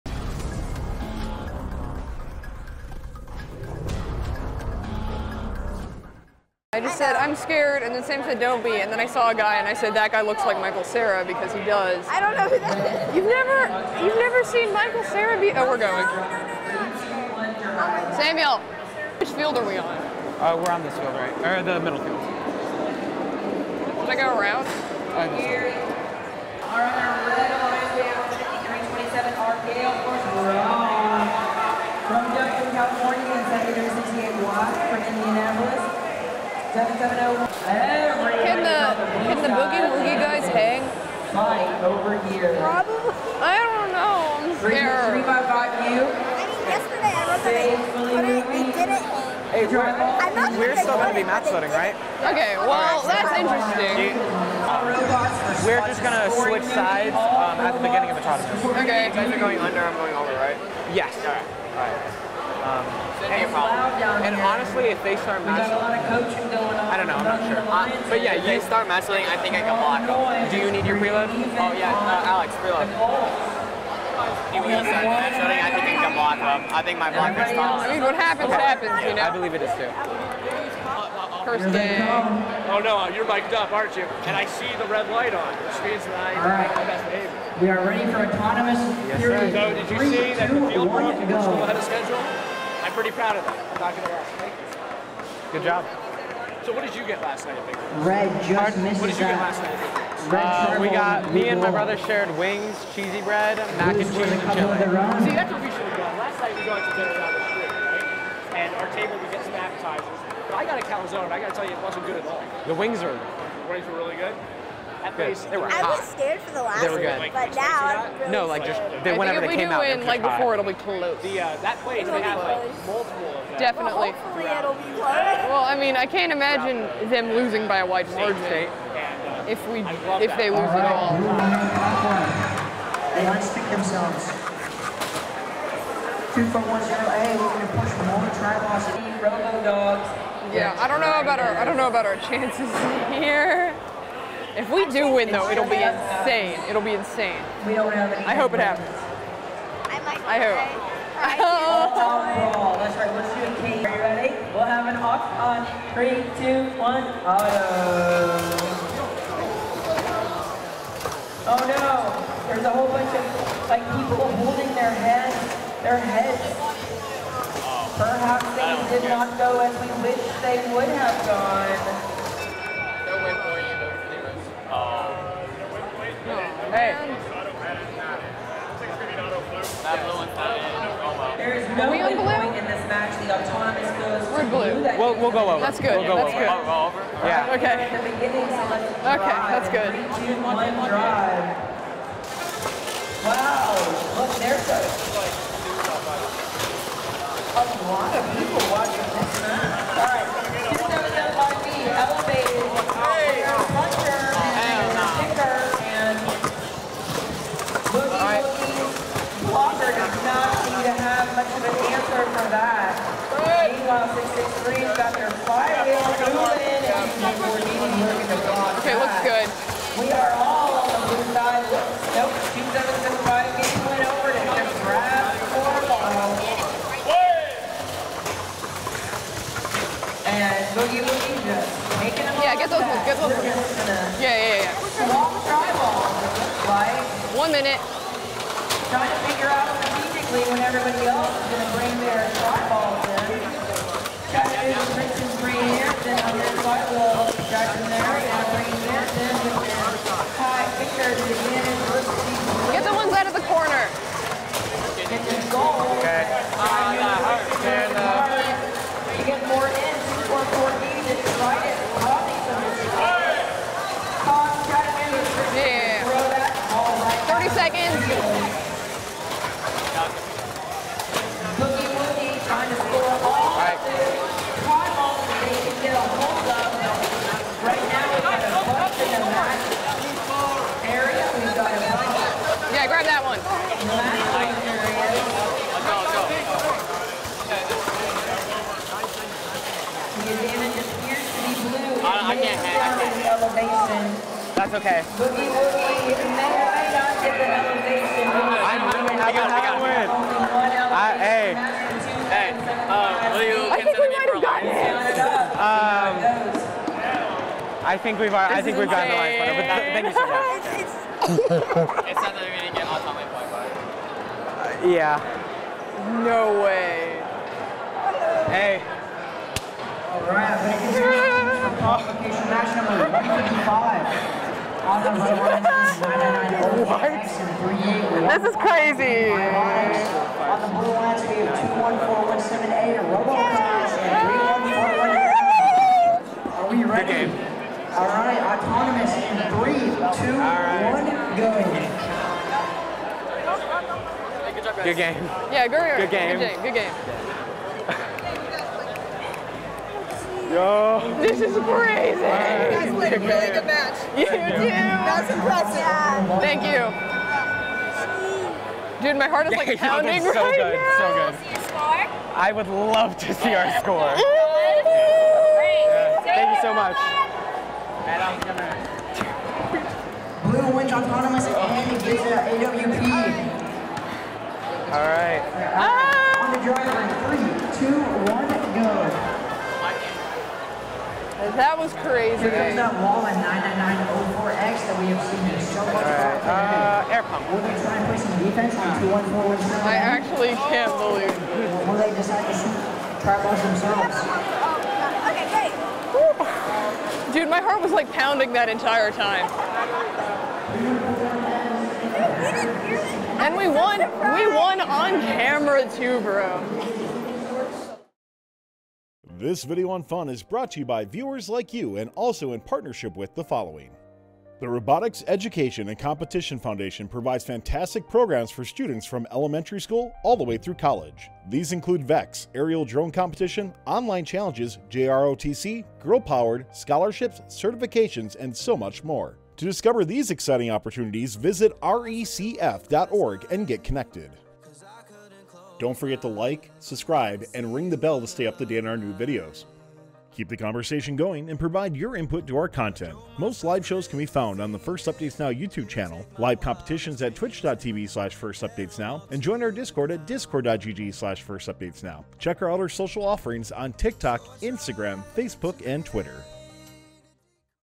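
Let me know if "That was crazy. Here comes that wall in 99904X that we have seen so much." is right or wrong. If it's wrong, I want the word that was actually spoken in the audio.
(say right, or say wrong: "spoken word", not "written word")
right.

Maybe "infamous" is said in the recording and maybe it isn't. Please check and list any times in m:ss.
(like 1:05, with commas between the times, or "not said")
not said.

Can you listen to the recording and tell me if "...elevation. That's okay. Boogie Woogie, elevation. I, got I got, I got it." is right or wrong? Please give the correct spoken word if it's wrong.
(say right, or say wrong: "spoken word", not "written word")
right.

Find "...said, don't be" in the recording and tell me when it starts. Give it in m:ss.
0:08.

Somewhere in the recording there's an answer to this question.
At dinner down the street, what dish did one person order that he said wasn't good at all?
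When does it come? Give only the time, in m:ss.
1:50.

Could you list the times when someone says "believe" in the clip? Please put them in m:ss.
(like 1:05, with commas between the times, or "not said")
1:19, 6:31.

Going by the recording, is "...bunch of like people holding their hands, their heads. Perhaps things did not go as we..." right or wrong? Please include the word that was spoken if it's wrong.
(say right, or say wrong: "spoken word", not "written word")
right.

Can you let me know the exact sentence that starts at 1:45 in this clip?
See, that's what we should have done.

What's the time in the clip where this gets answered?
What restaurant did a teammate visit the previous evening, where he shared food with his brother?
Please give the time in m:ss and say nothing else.
1:37.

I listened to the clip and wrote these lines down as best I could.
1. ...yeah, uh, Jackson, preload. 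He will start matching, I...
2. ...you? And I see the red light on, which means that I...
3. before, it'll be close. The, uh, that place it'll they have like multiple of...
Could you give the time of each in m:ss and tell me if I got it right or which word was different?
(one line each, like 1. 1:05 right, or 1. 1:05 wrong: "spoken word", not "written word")
1. 1:11 wrong: "Alex", not "Jackson"
2. 1:23 right
3. 2:00 right.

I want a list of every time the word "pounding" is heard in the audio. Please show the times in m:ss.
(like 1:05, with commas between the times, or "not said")
5:59, 6:38.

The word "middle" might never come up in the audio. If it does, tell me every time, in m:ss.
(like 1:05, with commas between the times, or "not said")
0:21.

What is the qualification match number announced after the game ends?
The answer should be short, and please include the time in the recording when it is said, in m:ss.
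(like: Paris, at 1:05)
155, at 5:23.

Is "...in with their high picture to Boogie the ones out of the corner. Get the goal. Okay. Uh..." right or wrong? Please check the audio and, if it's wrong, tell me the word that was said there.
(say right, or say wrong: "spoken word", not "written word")
wrong: "Get", not "Boogie".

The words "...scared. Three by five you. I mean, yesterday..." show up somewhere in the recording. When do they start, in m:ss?
0:44.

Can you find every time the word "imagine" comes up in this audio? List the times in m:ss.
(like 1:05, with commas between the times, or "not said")
2:06.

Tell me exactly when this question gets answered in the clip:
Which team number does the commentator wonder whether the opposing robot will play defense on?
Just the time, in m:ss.
6:29.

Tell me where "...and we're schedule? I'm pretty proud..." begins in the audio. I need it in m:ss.
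1:31.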